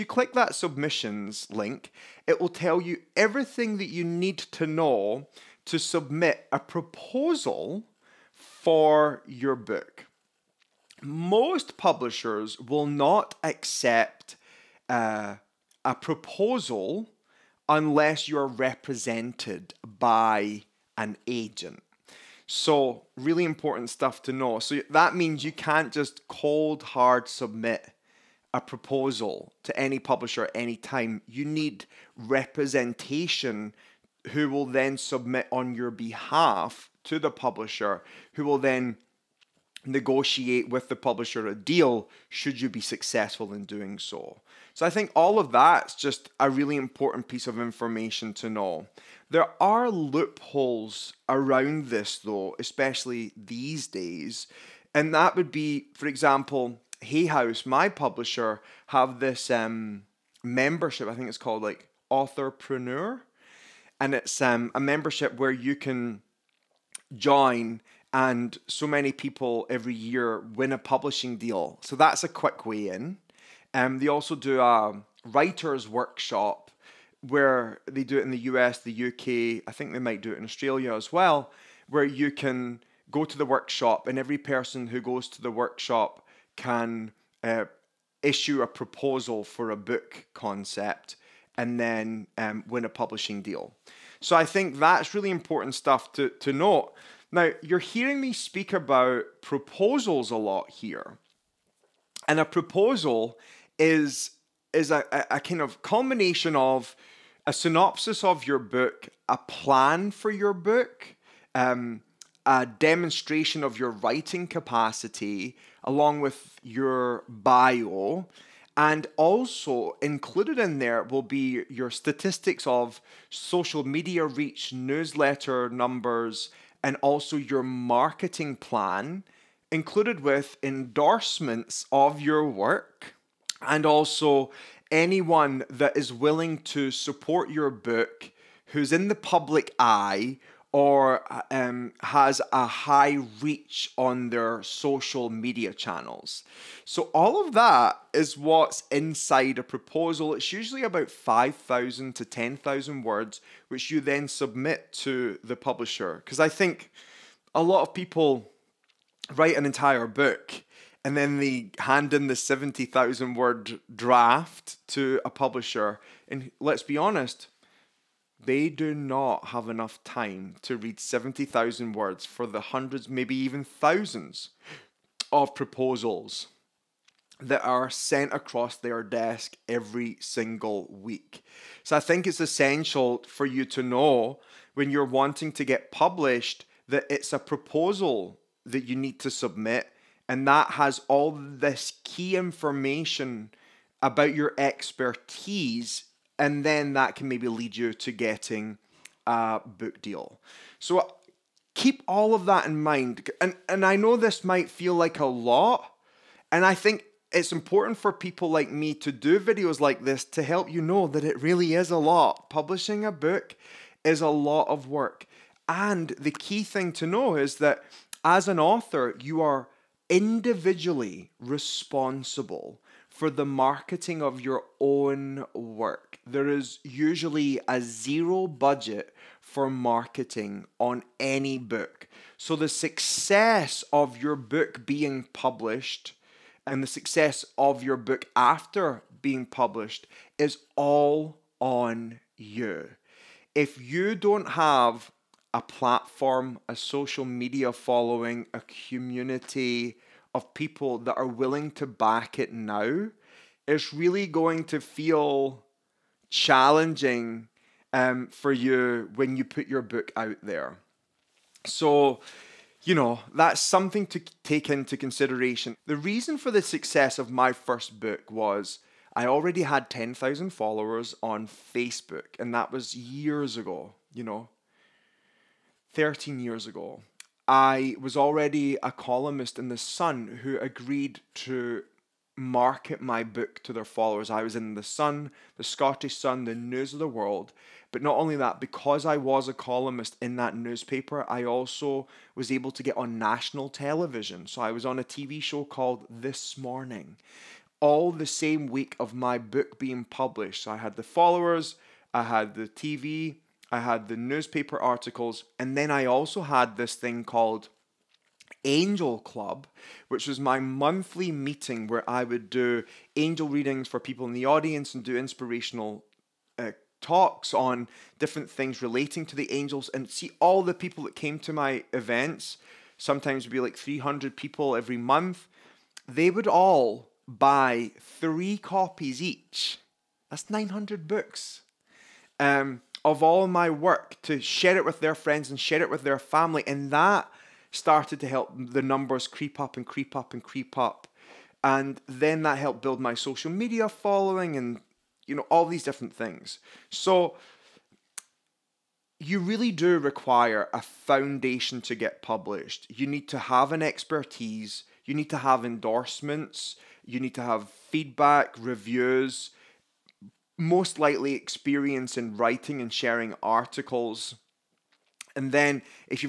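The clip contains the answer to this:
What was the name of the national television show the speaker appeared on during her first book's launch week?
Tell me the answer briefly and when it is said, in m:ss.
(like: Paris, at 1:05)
This Morning, at 4:56.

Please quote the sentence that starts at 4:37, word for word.
I was already a columnist in The Sun who agreed to market my book to their followers.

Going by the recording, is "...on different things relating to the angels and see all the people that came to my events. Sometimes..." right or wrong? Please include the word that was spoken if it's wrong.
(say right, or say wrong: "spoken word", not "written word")
right.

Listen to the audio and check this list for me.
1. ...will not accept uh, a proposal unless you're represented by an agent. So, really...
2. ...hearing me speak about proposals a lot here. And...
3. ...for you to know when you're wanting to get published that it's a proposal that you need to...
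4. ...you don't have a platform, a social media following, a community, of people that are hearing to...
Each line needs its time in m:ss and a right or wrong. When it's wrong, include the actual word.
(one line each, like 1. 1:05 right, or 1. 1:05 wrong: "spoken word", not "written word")
1. 0:12 right
2. 1:37 right
3. 3:03 right
4. 4:03 wrong: "willing", not "hearing".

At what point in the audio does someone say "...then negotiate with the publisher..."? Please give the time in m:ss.
0:38.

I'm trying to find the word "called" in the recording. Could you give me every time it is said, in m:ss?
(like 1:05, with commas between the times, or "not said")
1:01, 4:55, 5:07.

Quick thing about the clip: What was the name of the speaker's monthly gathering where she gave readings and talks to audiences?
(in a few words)
Angel Club.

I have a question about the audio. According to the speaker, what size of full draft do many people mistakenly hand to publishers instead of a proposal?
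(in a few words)
70,000 words.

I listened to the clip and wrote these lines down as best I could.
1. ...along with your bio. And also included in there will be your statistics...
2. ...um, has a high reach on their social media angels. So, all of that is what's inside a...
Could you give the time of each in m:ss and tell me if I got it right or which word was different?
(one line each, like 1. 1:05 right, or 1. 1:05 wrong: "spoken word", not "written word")
1. 1:55 right
2. 2:21 wrong: "channels", not "angels".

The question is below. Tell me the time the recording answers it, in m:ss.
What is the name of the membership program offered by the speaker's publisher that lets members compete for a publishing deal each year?
1:02.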